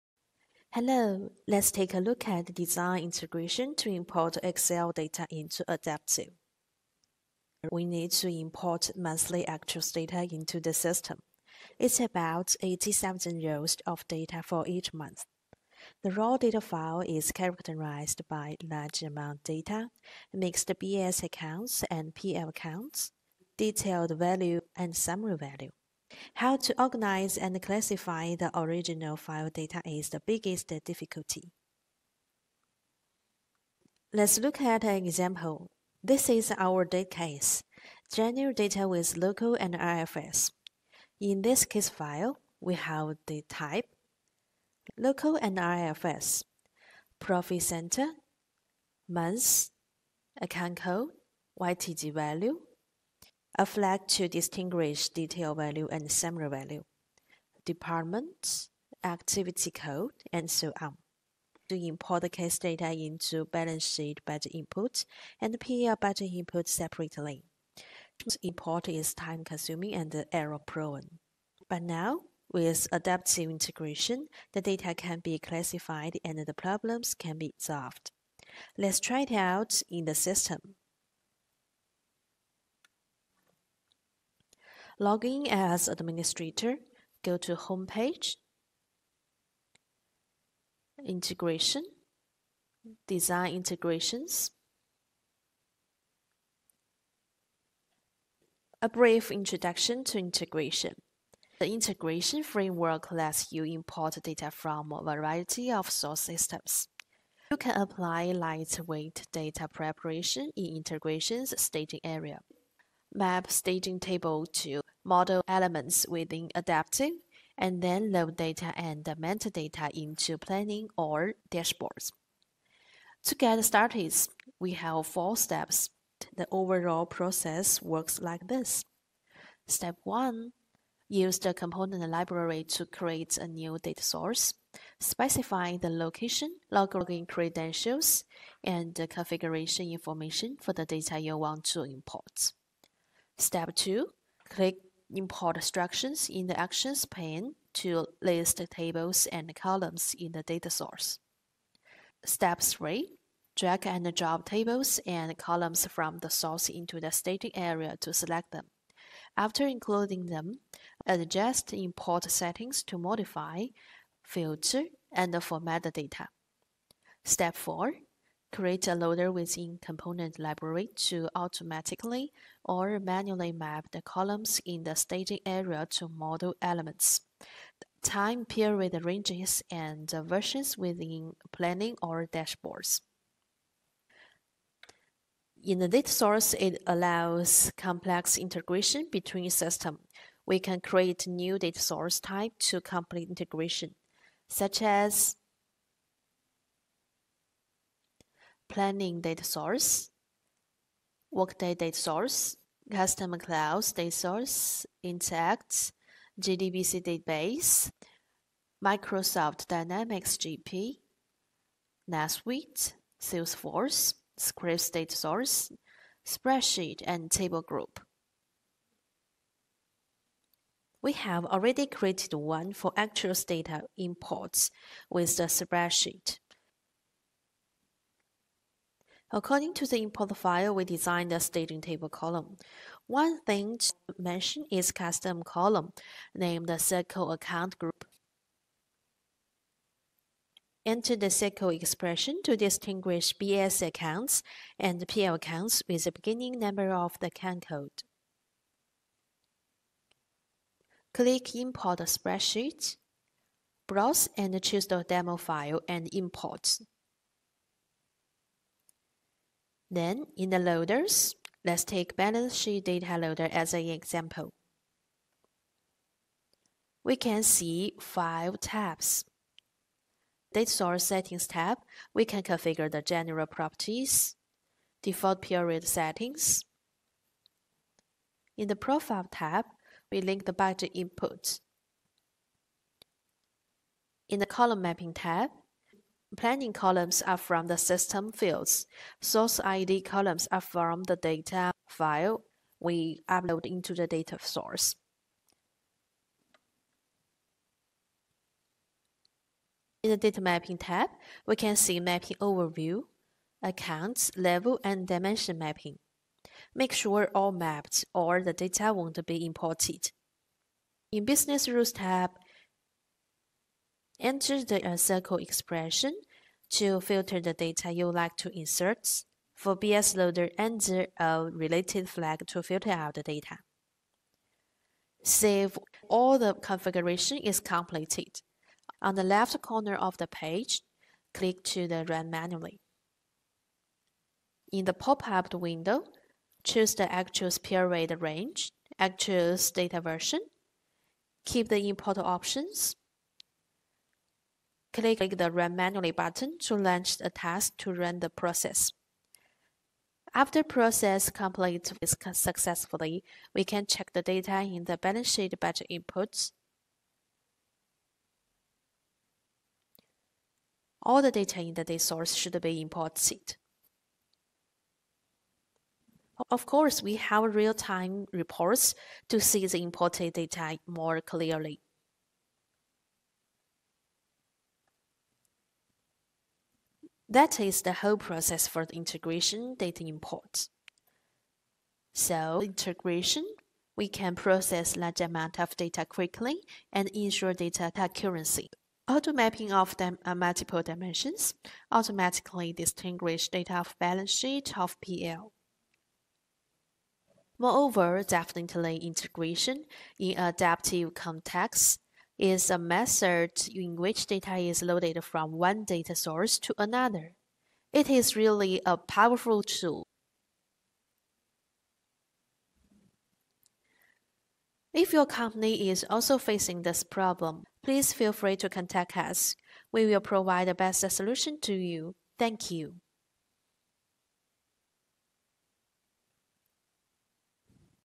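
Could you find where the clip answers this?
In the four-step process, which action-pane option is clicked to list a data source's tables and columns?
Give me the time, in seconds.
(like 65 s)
145 s.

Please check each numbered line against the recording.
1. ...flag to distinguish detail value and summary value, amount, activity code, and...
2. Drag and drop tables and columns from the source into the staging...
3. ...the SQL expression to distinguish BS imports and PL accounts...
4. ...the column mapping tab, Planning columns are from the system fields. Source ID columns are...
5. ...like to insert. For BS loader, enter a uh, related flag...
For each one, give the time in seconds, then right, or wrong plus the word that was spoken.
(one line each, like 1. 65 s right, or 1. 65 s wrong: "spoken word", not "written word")
1. 53 s wrong: "department", not "amount"
2. 153 s right
3. 241 s wrong: "accounts", not "imports"
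4. 284 s right
5. 318 s right.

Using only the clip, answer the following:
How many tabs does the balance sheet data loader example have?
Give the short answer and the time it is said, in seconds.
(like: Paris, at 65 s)
5, at 267 s.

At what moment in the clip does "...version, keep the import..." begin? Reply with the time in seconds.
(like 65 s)
339 s.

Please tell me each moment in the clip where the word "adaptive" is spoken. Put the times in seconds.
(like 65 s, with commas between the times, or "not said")
5 s, 72 s, 116 s, 400 s.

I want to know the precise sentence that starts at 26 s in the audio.
How to organize and classify the original file data is the biggest difficulty.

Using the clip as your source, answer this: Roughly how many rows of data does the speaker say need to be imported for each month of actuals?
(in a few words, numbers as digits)
80,000.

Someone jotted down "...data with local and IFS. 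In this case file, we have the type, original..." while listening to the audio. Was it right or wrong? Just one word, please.
wrong.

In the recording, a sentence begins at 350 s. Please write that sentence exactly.
After process completes successfully, we can check the data in the balance sheet budget inputs.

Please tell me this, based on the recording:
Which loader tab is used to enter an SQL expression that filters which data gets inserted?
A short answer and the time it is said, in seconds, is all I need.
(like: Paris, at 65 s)
Business Rules, at 311 s.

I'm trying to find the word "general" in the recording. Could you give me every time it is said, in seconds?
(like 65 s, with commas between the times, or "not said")
38 s, 273 s.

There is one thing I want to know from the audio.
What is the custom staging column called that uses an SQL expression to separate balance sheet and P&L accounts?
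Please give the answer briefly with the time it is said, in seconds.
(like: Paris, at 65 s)
circle account group, at 236 s.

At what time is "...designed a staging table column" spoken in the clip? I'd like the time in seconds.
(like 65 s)
230 s.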